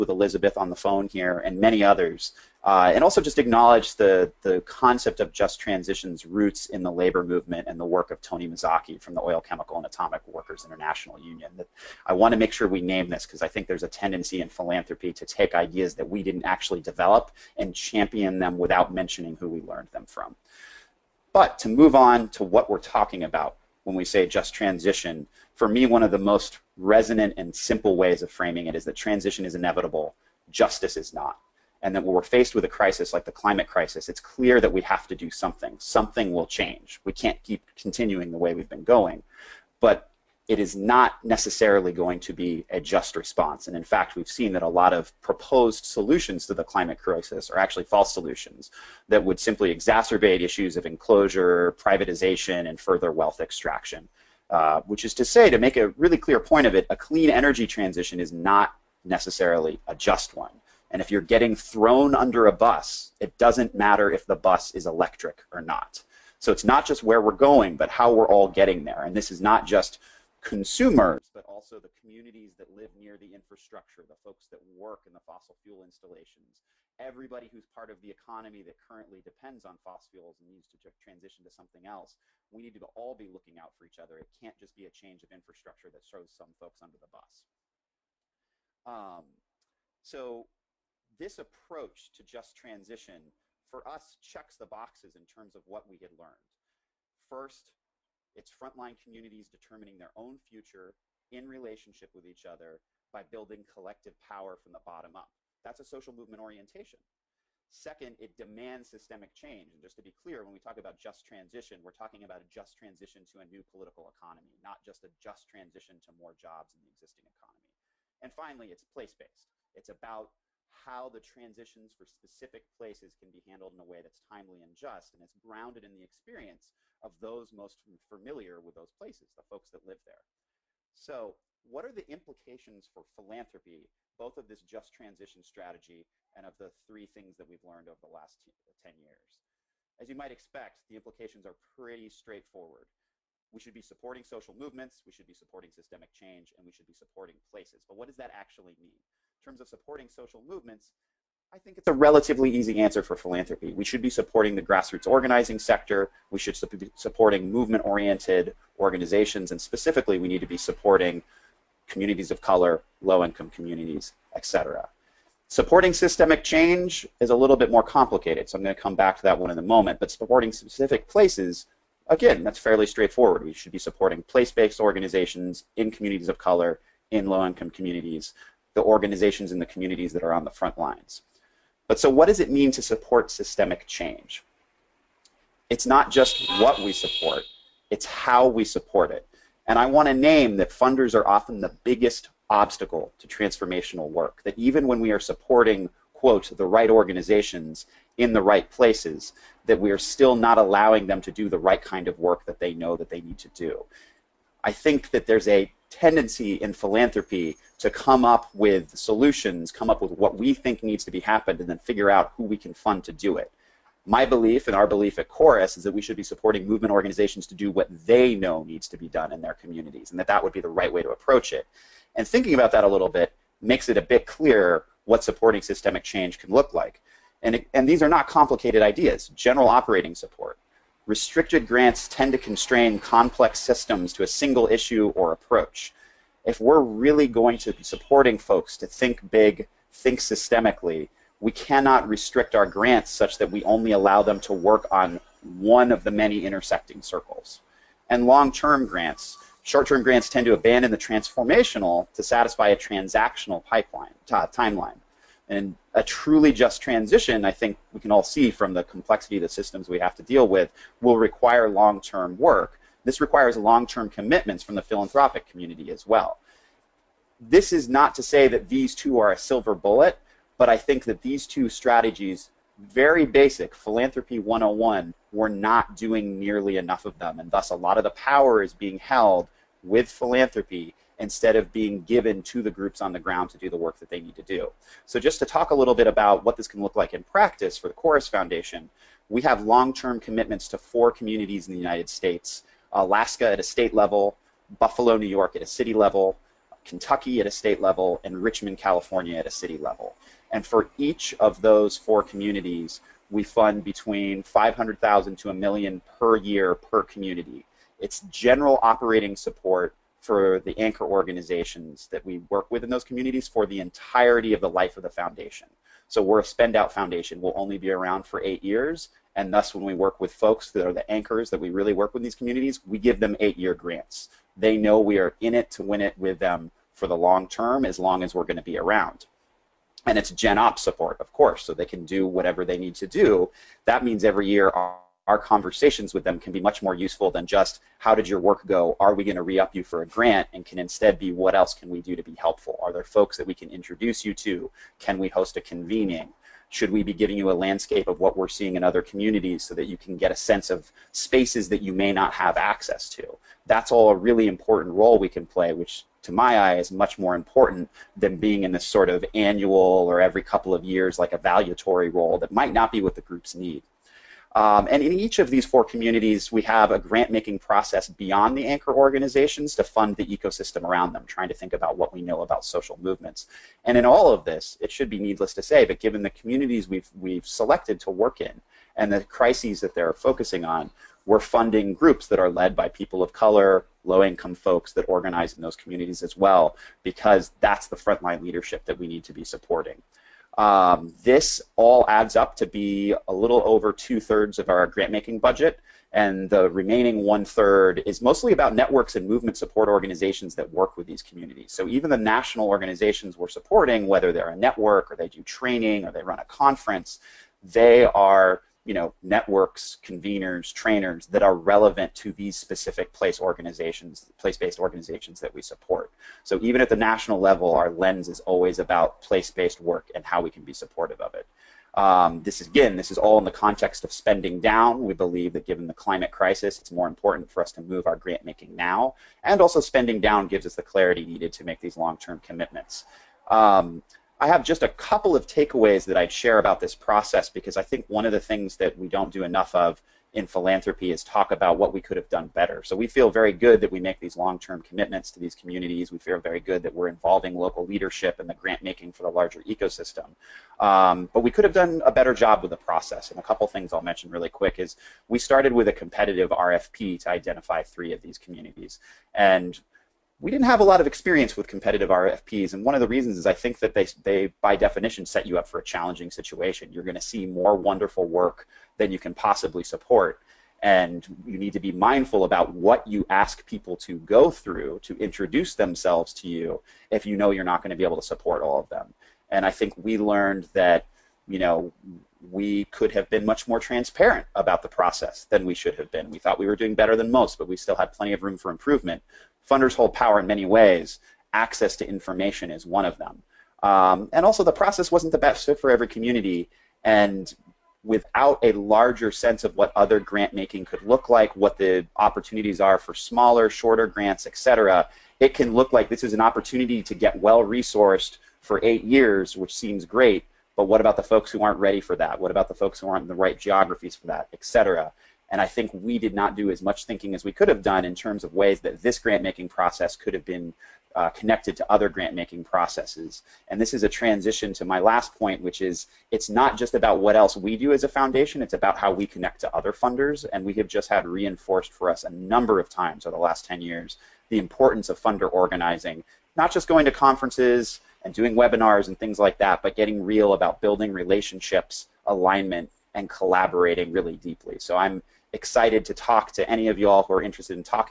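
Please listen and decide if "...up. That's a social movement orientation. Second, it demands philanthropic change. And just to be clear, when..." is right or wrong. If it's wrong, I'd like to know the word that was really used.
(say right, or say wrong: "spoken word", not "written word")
wrong: "systemic", not "philanthropic".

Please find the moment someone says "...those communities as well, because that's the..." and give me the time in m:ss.
6:25.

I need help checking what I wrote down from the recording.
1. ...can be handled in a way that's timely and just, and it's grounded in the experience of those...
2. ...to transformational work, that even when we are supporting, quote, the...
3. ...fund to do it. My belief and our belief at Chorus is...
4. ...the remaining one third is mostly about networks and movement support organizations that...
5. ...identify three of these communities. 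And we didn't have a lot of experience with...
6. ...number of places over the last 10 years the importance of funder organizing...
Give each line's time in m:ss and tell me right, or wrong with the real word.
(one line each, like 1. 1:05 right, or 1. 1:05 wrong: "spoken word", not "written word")
1. 2:03 right
2. 3:13 right
3. 3:32 right
4. 6:36 right
5. 7:37 right
6. 8:52 wrong: "times", not "places".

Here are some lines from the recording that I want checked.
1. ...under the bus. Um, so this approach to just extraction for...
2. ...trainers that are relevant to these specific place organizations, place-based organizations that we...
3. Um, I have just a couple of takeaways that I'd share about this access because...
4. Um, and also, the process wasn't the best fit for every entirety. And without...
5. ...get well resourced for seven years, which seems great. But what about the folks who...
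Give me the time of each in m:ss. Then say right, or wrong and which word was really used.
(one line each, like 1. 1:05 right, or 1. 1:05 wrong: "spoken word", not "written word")
1. 1:26 wrong: "transition", not "extraction"
2. 6:50 right
3. 7:13 wrong: "process", not "access"
4. 8:13 wrong: "community", not "entirety"
5. 8:27 wrong: "eight", not "seven".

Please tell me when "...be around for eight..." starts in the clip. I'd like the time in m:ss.
5:17.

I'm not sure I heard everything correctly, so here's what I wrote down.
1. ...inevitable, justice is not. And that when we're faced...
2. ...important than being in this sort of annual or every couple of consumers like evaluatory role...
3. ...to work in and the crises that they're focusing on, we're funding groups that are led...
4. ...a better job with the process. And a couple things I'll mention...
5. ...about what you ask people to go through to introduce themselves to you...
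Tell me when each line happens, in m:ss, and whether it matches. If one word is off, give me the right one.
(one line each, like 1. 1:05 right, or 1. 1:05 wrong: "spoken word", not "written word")
1. 0:29 right
2. 5:57 wrong: "years", not "consumers"
3. 6:18 right
4. 7:32 right
5. 7:52 right.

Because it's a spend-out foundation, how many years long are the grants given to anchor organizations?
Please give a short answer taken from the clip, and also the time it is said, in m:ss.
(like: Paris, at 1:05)
8, at 5:23.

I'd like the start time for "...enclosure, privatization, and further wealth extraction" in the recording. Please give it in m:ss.
0:50.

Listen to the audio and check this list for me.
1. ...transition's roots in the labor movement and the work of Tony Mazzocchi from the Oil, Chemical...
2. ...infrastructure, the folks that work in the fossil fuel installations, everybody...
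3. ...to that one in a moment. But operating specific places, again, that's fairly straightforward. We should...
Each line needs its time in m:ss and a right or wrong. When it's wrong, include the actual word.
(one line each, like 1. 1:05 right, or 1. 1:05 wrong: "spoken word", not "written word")
1. 0:05 right
2. 1:13 right
3. 2:49 wrong: "supporting", not "operating".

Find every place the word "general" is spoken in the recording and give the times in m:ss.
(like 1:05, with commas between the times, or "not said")
3:49, 5:08.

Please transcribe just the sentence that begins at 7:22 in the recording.
So we feel very good that we make these long-term commitments to these communities.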